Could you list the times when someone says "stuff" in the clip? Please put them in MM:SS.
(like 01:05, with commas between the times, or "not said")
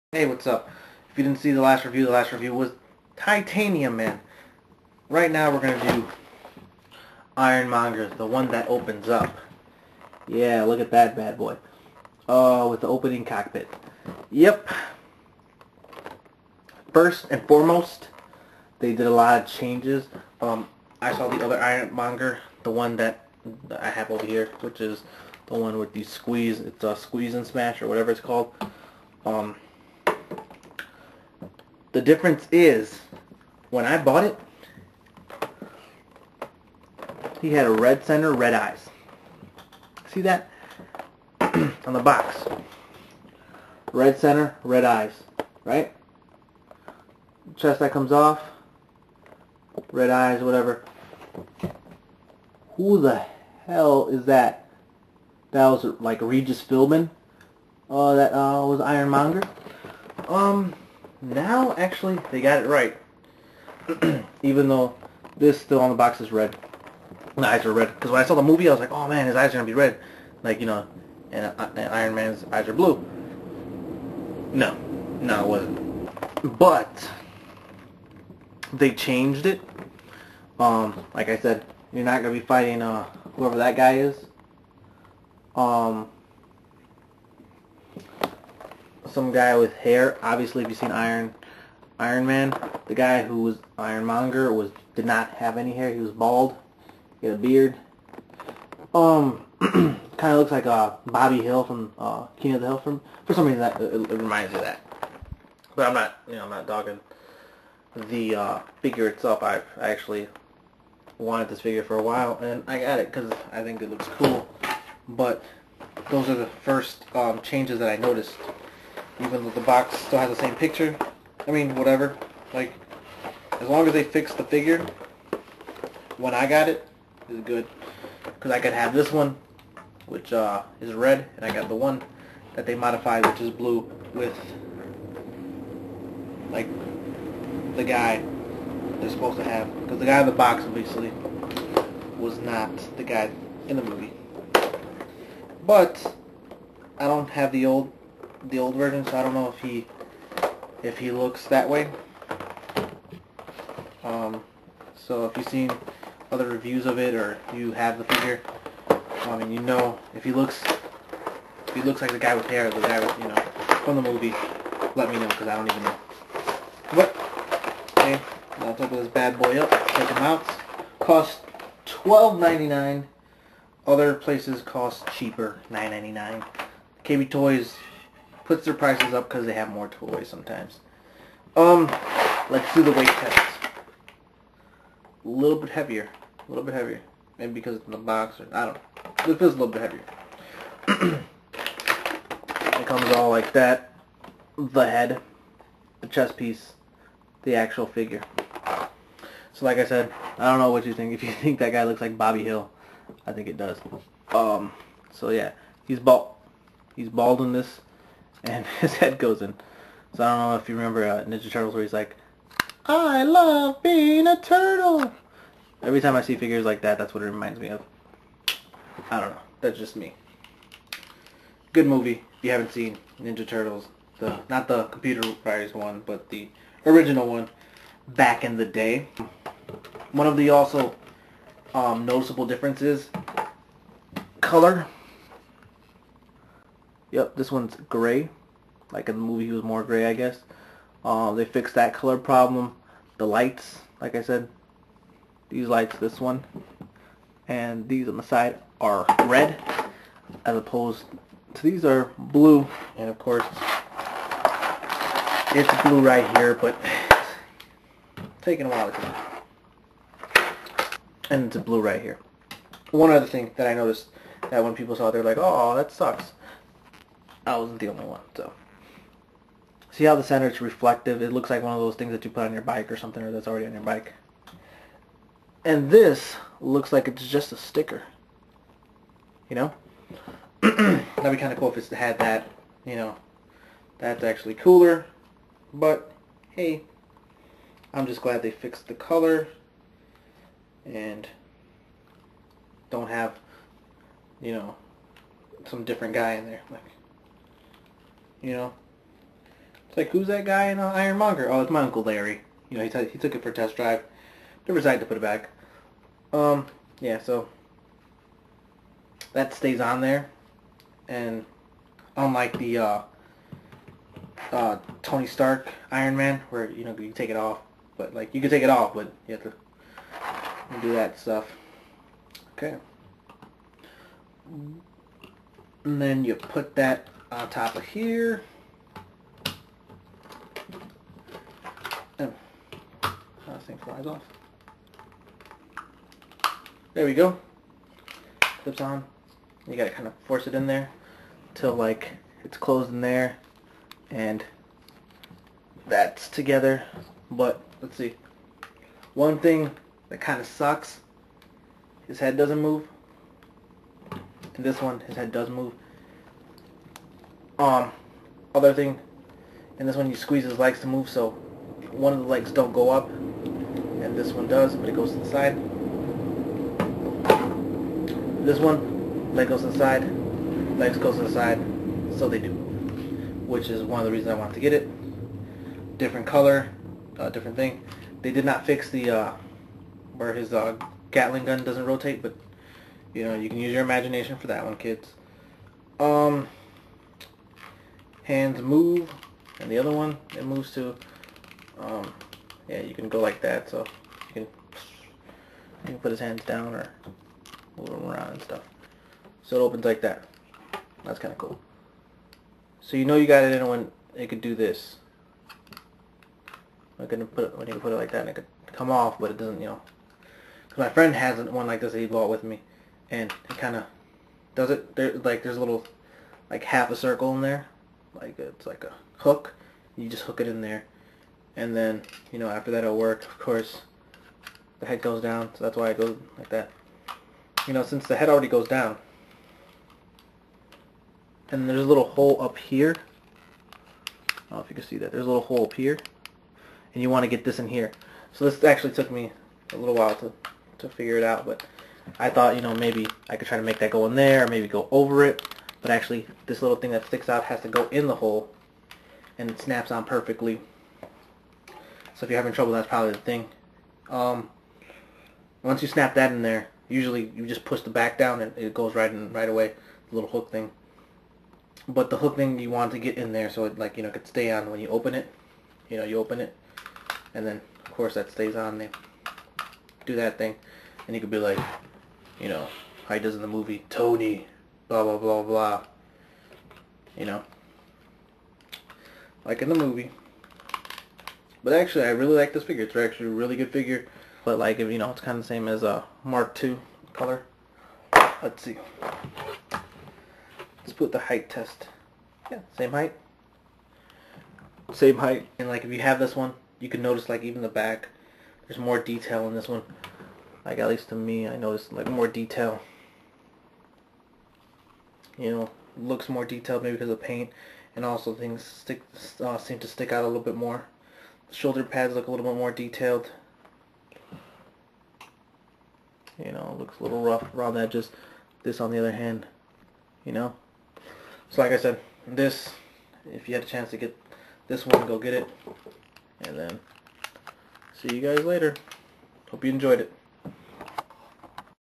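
05:21, 06:38.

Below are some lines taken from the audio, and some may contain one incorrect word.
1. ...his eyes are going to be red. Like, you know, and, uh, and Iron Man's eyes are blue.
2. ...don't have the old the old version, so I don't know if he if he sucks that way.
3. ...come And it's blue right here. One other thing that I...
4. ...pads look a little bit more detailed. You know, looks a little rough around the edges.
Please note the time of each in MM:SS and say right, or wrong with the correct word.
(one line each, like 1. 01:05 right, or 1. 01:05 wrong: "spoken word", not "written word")
1. 01:09 right
2. 02:27 wrong: "looks", not "sucks"
3. 04:20 right
4. 08:31 right.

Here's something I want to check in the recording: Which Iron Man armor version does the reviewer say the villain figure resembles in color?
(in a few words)
Mark II.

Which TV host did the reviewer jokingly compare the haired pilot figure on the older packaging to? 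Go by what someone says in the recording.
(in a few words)
Regis Philbin.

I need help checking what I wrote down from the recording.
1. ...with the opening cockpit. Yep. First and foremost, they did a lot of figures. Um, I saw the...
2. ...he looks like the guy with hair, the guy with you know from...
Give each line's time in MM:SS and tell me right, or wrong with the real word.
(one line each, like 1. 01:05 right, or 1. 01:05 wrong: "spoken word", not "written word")
1. 00:12 wrong: "changes", not "figures"
2. 02:41 right.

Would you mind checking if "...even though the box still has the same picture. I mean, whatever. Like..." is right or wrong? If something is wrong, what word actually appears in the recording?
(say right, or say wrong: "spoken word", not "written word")
right.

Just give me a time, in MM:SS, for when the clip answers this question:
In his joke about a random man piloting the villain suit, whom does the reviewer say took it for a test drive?
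05:01.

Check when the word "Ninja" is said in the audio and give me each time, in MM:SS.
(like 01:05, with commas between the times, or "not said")
03:31, 03:43.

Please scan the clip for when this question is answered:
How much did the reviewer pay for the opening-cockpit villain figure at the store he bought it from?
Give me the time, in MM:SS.
02:51.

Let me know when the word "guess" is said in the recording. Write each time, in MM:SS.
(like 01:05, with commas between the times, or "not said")
04:00.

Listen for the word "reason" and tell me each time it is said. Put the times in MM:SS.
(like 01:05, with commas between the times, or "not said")
01:43, 06:14.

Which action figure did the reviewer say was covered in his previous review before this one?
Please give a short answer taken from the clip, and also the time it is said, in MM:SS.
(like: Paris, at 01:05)
Titanium Man, at 00:03.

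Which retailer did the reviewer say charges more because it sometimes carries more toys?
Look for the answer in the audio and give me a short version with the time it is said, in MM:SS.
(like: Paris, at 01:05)
KB Toys, at 02:57.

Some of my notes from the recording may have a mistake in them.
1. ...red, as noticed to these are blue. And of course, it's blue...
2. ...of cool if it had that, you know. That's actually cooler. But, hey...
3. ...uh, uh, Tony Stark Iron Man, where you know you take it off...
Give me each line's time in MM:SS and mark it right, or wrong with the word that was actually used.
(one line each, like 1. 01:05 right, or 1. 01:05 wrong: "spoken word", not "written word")
1. 04:09 wrong: "opposed", not "noticed"
2. 04:41 right
3. 05:12 right.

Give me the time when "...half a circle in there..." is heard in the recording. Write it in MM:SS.
06:56.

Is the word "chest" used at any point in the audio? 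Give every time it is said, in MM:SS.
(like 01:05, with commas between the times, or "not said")
00:47, 03:16.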